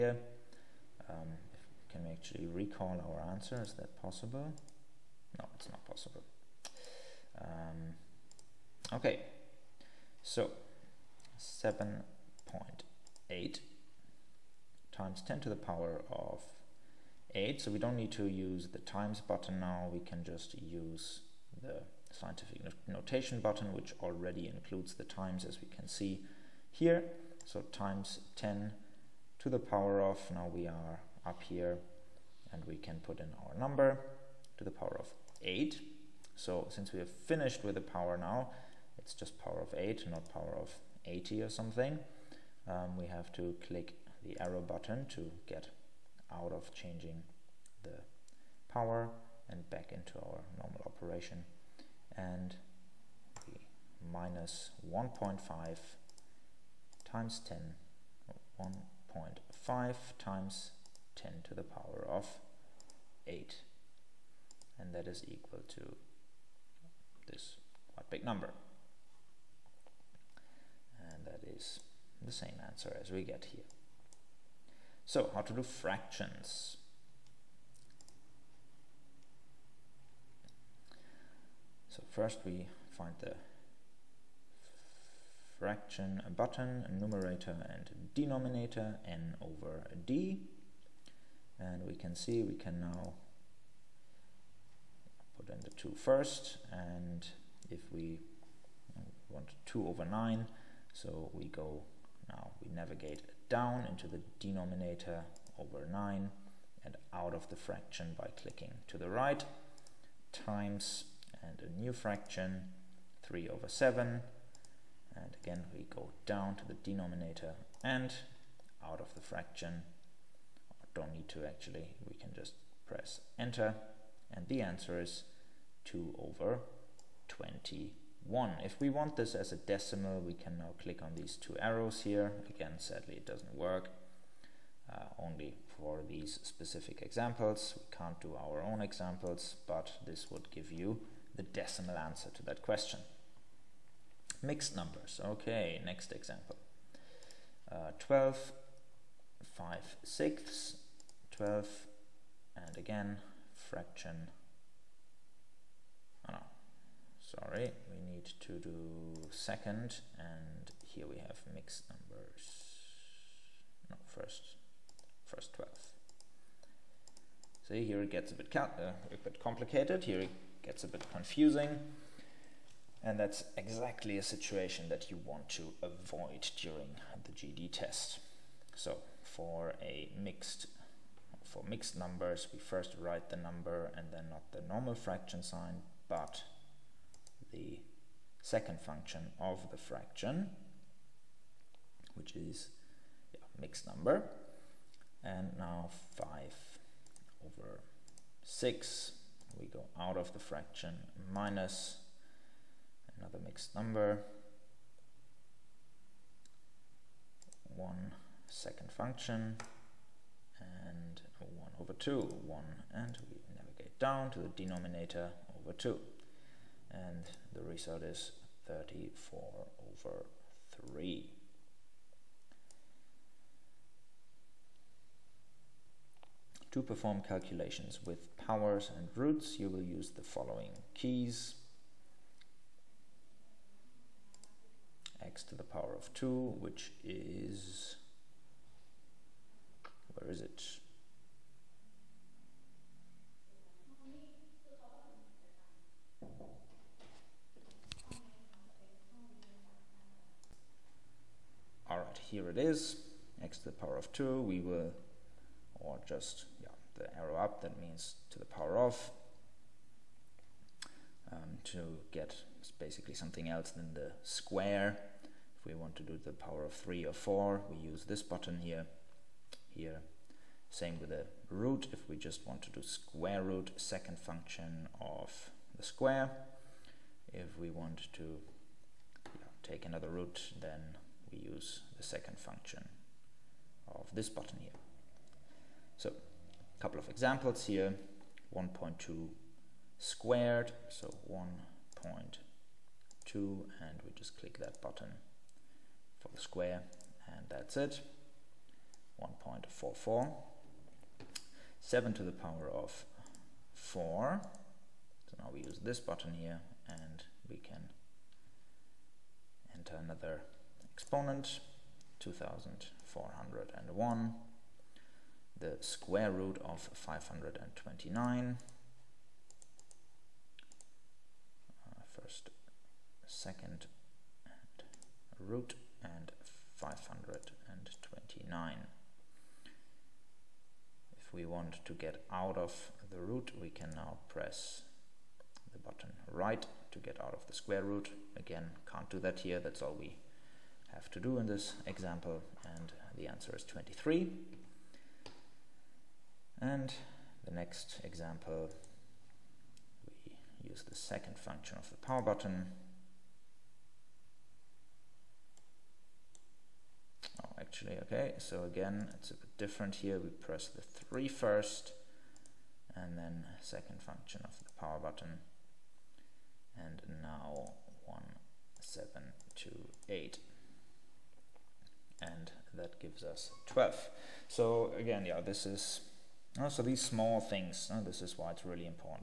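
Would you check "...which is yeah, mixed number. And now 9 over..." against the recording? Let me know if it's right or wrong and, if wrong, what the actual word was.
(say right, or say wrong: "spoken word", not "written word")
wrong: "5", not "9".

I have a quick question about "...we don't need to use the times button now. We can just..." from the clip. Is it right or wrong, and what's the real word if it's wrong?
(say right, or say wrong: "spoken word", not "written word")
right.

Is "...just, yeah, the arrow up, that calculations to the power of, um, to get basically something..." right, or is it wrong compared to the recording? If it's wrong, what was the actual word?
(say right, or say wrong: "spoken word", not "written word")
wrong: "means", not "calculations".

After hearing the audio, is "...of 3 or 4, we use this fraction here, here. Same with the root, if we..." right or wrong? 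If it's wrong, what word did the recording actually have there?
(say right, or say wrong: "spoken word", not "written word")
wrong: "button", not "fraction".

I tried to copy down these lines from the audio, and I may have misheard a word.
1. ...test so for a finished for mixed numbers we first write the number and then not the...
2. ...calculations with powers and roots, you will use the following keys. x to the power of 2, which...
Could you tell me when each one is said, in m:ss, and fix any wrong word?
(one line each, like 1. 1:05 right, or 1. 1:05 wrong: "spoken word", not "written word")
1. 2:57 wrong: "mixed", not "finished"
2. 3:47 right.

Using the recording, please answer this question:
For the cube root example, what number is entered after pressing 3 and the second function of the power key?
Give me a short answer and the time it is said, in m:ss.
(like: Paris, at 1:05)
1728, at 6:08.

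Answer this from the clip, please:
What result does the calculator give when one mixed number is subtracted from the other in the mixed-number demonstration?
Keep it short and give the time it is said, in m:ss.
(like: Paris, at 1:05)
34/3, at 3:38.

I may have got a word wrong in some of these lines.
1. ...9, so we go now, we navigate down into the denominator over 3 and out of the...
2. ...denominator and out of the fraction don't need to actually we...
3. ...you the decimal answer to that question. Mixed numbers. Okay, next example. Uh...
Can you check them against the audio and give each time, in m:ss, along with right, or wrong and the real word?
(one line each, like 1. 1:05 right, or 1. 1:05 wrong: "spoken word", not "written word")
1. 1:40 wrong: "9", not "3"
2. 1:56 right
3. 2:20 right.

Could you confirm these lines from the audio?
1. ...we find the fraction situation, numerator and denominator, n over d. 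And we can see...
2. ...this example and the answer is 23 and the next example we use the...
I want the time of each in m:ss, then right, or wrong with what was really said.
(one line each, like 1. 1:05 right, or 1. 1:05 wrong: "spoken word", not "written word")
1. 1:22 wrong: "button", not "situation"
2. 5:41 right.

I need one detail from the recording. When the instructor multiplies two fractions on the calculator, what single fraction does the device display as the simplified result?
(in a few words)
2/21.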